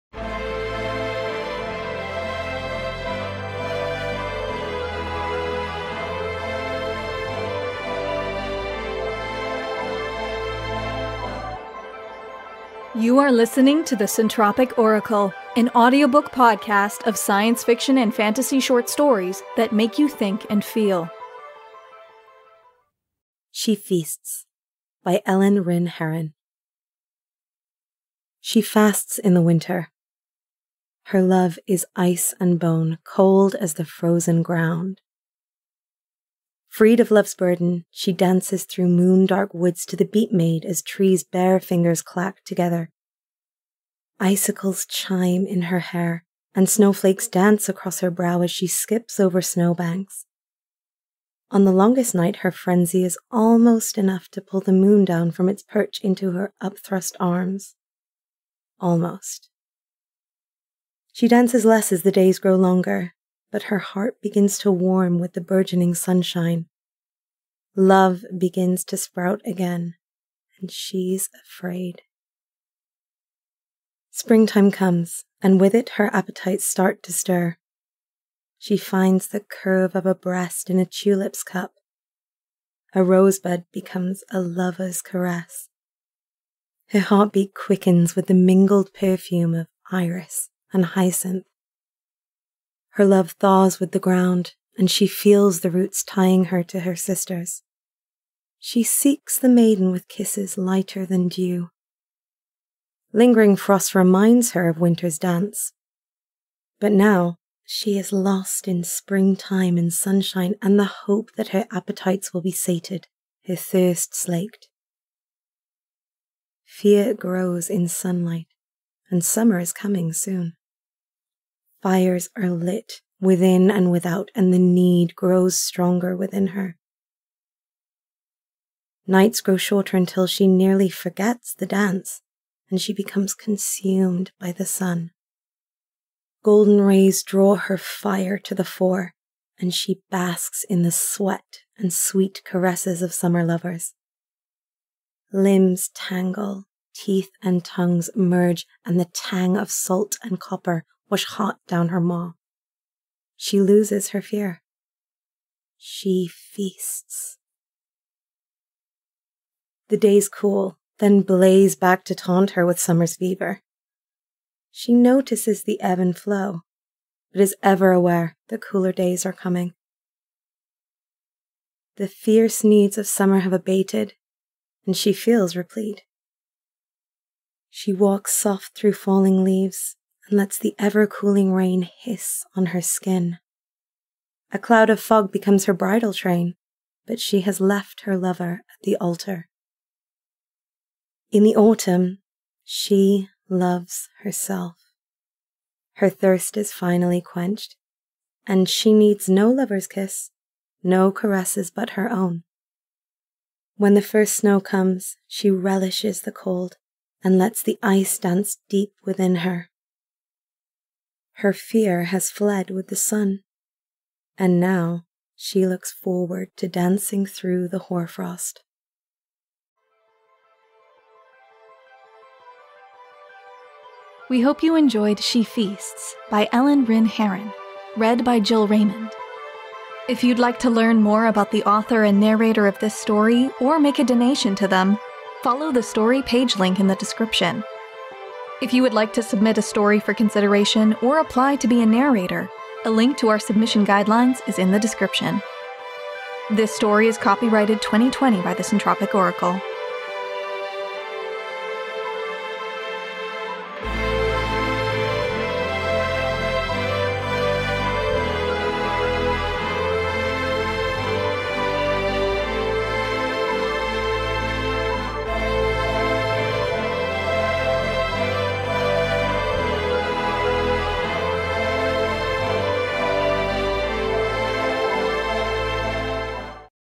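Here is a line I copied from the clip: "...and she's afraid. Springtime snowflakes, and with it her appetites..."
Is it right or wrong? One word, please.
wrong.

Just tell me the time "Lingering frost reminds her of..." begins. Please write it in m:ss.
1:43.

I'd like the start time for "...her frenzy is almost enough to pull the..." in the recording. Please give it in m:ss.
0:52.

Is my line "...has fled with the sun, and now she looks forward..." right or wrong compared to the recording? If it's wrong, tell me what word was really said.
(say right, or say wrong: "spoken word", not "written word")
right.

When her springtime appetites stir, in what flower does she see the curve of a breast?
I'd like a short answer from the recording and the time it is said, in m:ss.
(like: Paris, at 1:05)
Tulip, at 1:20.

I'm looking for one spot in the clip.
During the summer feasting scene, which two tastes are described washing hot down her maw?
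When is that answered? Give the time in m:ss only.
2:29.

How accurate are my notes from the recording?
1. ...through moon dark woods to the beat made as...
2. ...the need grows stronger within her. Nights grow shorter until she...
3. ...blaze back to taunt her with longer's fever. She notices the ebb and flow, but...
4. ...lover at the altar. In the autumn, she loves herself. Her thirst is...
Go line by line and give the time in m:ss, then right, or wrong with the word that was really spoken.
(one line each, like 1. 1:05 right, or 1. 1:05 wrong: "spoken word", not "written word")
1. 0:38 right
2. 2:04 right
3. 2:41 wrong: "summer", not "longer"
4. 3:08 right.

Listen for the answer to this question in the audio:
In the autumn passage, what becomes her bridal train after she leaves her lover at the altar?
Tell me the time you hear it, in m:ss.
3:04.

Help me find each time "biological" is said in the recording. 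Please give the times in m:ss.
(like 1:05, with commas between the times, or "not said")
not said.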